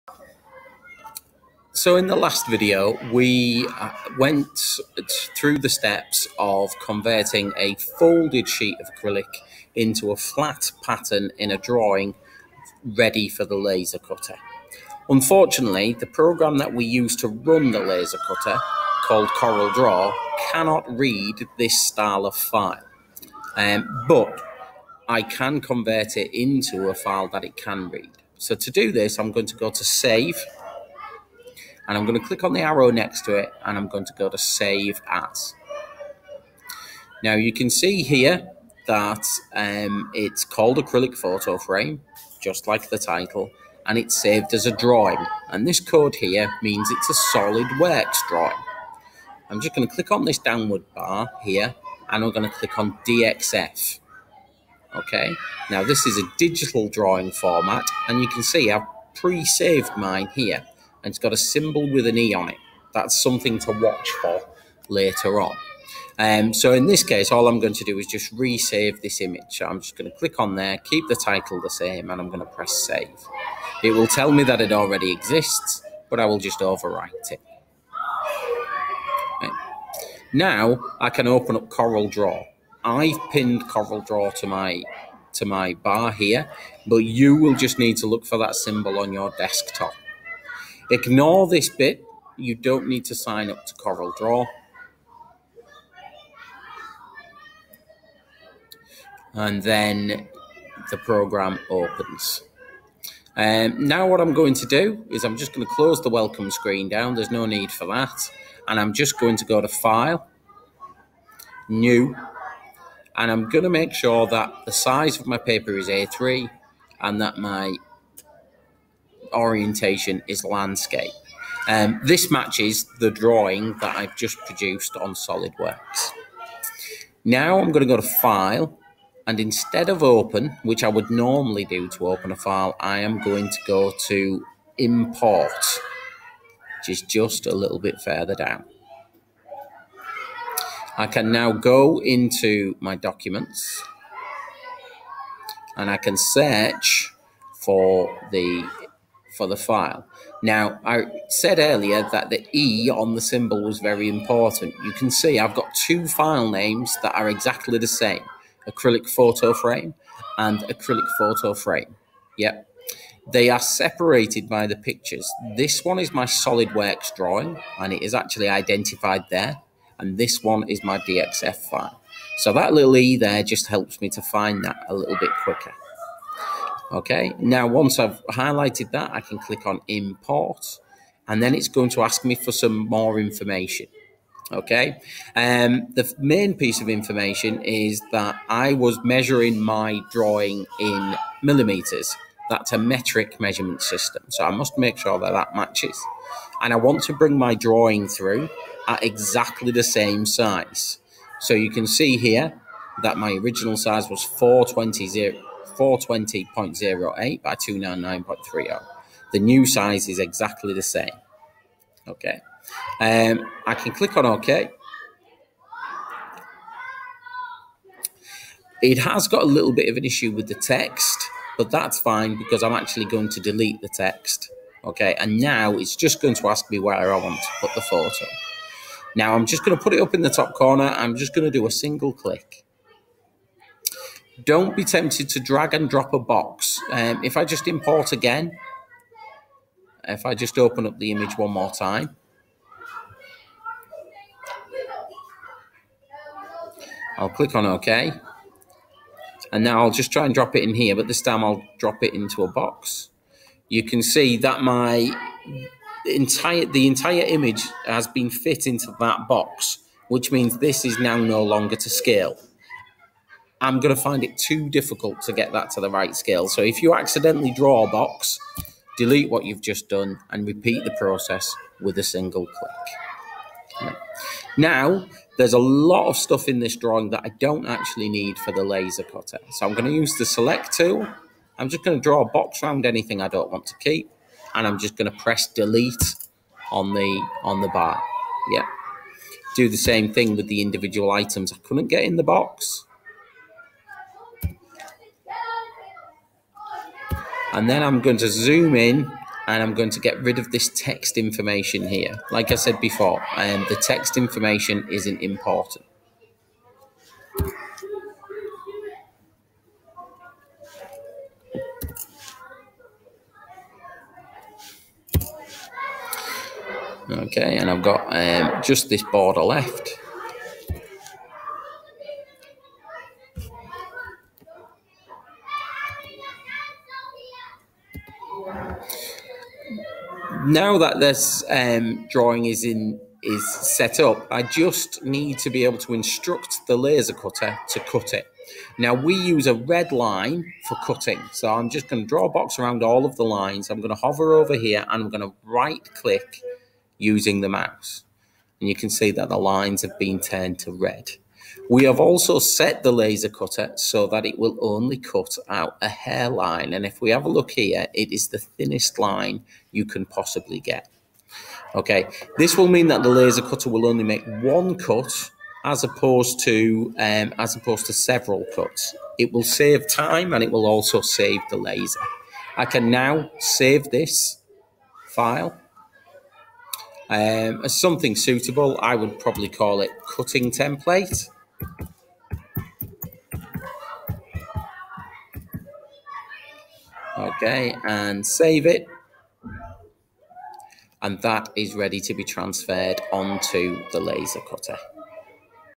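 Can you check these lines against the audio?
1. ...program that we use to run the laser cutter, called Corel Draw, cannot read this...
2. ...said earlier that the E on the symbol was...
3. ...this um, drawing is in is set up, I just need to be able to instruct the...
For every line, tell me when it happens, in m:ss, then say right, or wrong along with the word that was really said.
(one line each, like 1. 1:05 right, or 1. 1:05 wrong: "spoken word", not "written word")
1. 0:16 right
2. 2:31 right
3. 5:30 right.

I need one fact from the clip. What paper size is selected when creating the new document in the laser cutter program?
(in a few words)
A3.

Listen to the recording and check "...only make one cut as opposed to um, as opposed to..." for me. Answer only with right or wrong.
right.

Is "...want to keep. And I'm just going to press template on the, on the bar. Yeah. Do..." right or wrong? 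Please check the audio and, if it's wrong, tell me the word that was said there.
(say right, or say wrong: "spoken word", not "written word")
wrong: "delete", not "template".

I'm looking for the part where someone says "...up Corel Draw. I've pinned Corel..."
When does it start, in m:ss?
1:21.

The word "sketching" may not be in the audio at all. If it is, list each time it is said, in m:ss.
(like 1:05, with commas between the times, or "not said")
not said.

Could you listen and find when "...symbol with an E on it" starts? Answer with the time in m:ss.
1:01.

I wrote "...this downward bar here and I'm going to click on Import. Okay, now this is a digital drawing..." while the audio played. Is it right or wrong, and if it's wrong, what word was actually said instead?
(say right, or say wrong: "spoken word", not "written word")
wrong: "DXF", not "Import".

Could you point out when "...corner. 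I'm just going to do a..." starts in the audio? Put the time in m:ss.
3:50.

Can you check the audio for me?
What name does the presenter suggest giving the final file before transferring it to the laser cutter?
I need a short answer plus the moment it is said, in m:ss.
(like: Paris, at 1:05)
cutting template, at 6:20.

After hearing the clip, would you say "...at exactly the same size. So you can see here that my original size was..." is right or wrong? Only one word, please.
right.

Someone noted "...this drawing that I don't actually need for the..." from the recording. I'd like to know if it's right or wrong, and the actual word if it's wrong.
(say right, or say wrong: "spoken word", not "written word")
right.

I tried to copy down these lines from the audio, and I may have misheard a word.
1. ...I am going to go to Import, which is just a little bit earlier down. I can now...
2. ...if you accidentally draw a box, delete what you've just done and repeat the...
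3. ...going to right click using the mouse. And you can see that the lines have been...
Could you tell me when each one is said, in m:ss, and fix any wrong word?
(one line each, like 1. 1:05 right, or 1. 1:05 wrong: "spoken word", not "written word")
1. 2:12 wrong: "further", not "earlier"
2. 4:26 right
3. 5:45 right.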